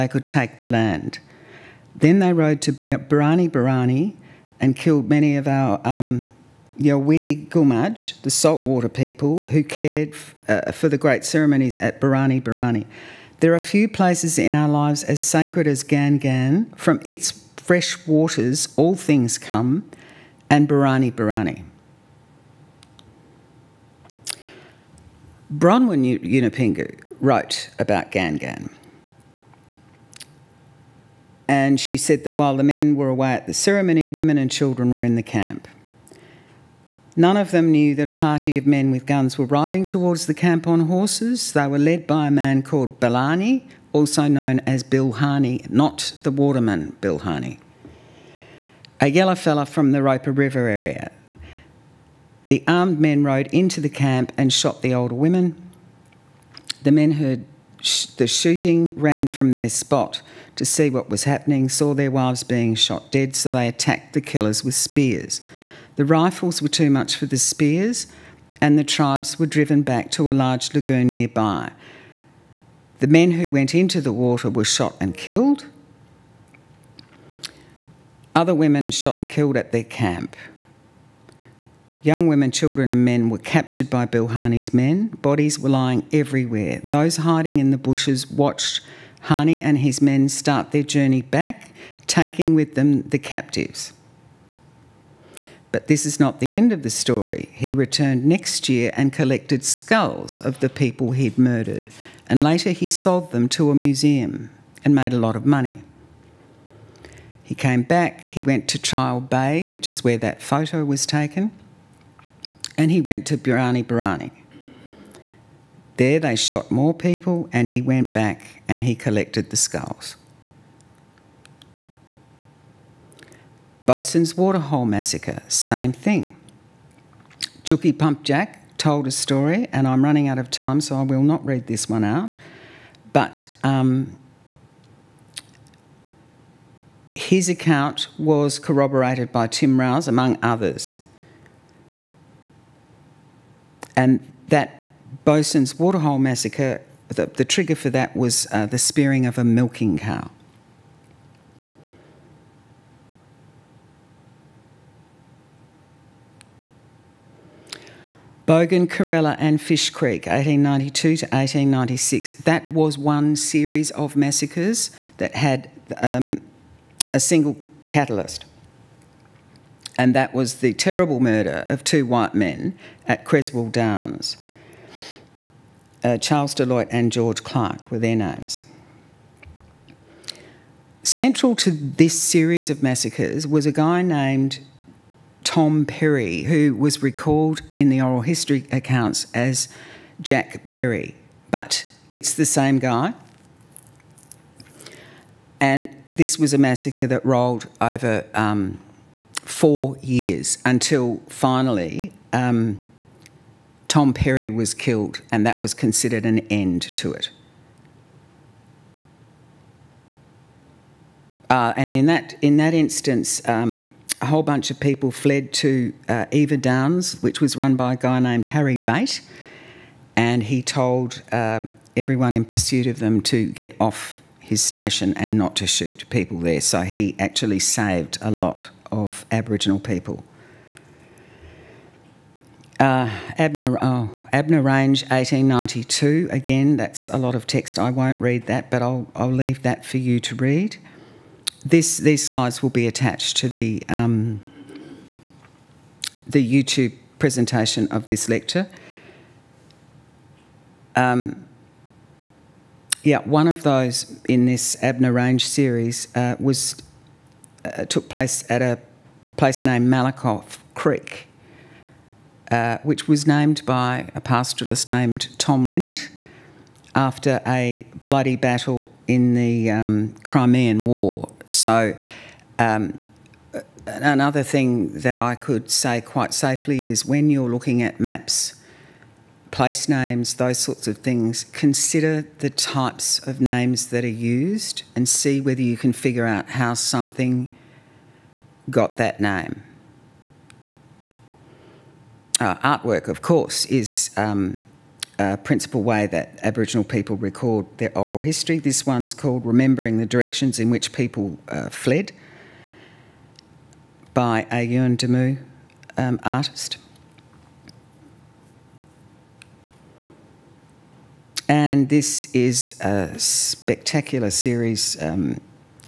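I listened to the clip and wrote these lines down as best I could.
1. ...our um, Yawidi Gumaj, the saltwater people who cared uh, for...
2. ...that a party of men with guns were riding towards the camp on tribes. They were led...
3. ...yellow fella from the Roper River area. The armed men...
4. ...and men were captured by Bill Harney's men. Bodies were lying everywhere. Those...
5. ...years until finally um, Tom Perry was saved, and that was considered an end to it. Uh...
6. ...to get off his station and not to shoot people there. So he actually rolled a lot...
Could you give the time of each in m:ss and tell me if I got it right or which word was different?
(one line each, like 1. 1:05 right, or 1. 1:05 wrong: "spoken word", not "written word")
1. 0:05 right
2. 0:37 wrong: "horses", not "tribes"
3. 0:49 right
4. 1:22 right
5. 3:20 wrong: "killed", not "saved"
6. 3:43 wrong: "saved", not "rolled".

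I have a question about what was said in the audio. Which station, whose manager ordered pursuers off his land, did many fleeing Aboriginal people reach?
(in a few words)
Eva Downs.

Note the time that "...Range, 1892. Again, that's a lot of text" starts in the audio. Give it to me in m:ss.
3:54.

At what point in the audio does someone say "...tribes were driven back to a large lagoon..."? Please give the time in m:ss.
1:08.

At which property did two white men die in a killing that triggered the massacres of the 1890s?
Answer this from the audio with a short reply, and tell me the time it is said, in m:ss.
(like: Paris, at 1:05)
Creswell Downs, at 2:53.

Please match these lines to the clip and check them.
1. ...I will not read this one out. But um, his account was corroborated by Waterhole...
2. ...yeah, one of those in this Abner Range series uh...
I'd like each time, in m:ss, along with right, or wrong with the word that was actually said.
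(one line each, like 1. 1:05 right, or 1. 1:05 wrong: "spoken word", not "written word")
1. 2:10 wrong: "Tim", not "Waterhole"
2. 4:13 right.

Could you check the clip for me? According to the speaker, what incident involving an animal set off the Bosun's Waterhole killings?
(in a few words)
spearing of a milking cow.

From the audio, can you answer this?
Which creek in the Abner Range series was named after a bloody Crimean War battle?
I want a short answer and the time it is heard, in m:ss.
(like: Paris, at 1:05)
Malakoff Creek, at 4:19.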